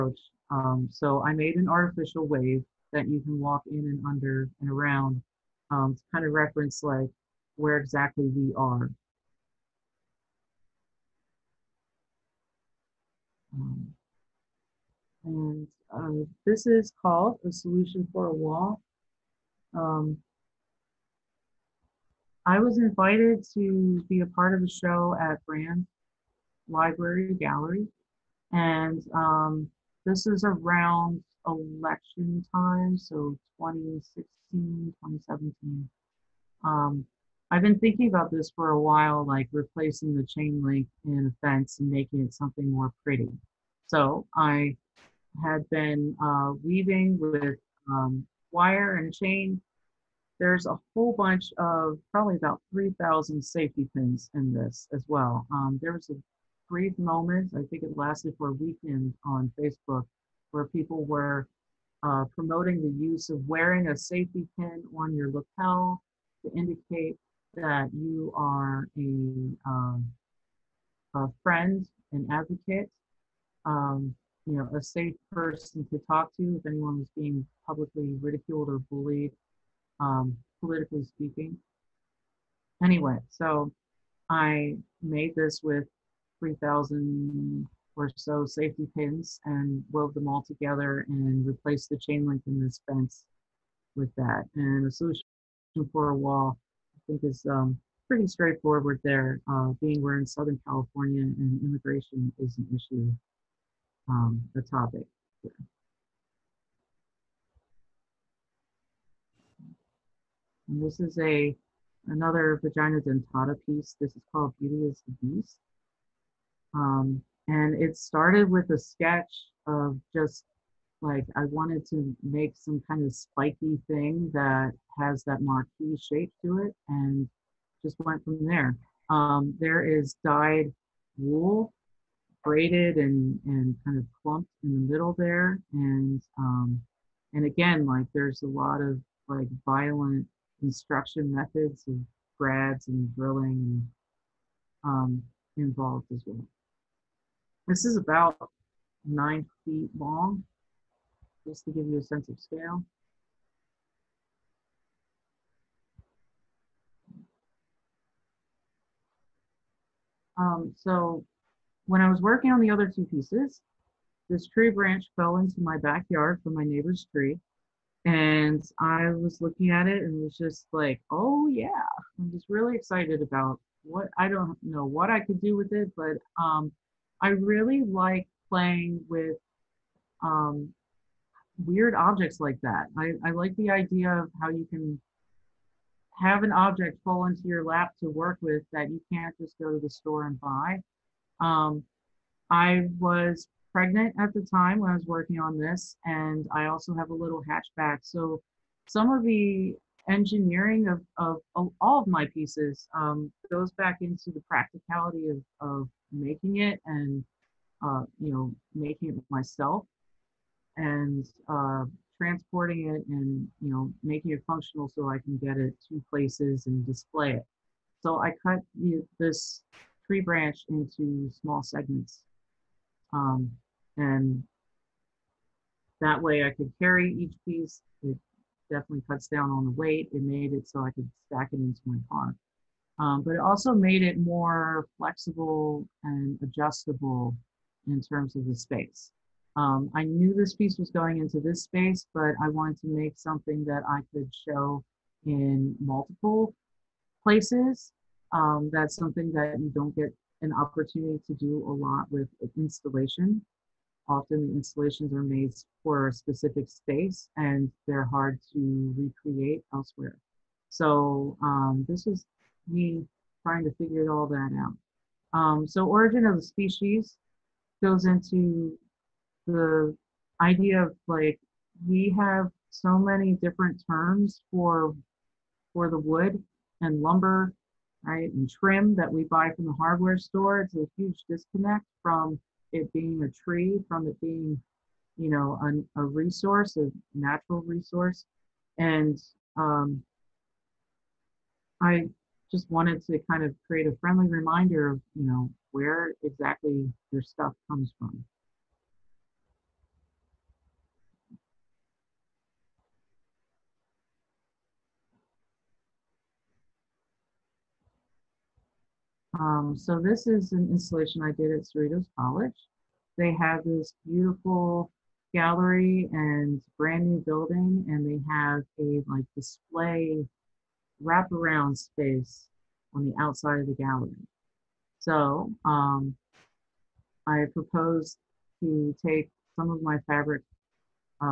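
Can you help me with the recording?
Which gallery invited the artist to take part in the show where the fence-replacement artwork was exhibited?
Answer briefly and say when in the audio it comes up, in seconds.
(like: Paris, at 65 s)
Brand Library Gallery, at 25 s.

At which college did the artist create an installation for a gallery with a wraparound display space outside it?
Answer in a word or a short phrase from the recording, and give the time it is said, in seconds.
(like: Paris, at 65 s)
Cerritos College, at 311 s.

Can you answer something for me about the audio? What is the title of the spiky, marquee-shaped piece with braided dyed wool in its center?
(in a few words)
Beauty is the Beast.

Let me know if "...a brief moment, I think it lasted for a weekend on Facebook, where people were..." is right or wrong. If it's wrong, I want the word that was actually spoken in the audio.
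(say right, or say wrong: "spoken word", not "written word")
right.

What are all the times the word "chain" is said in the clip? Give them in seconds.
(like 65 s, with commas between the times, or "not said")
40 s, 49 s, 91 s.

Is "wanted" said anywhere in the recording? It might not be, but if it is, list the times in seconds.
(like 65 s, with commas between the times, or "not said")
121 s, 242 s, 292 s.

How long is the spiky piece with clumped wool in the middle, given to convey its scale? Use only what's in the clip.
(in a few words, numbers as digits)
nine feet.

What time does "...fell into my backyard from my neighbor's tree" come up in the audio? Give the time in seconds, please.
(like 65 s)
165 s.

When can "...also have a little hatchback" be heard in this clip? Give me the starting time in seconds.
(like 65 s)
196 s.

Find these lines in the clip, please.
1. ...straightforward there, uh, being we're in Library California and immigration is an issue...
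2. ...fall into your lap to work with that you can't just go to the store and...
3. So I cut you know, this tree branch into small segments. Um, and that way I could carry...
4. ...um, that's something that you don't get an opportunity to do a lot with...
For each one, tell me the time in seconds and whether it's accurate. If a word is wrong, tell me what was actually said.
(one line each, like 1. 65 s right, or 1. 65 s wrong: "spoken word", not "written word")
1. 98 s wrong: "Southern", not "Library"
2. 187 s right
3. 218 s right
4. 248 s right.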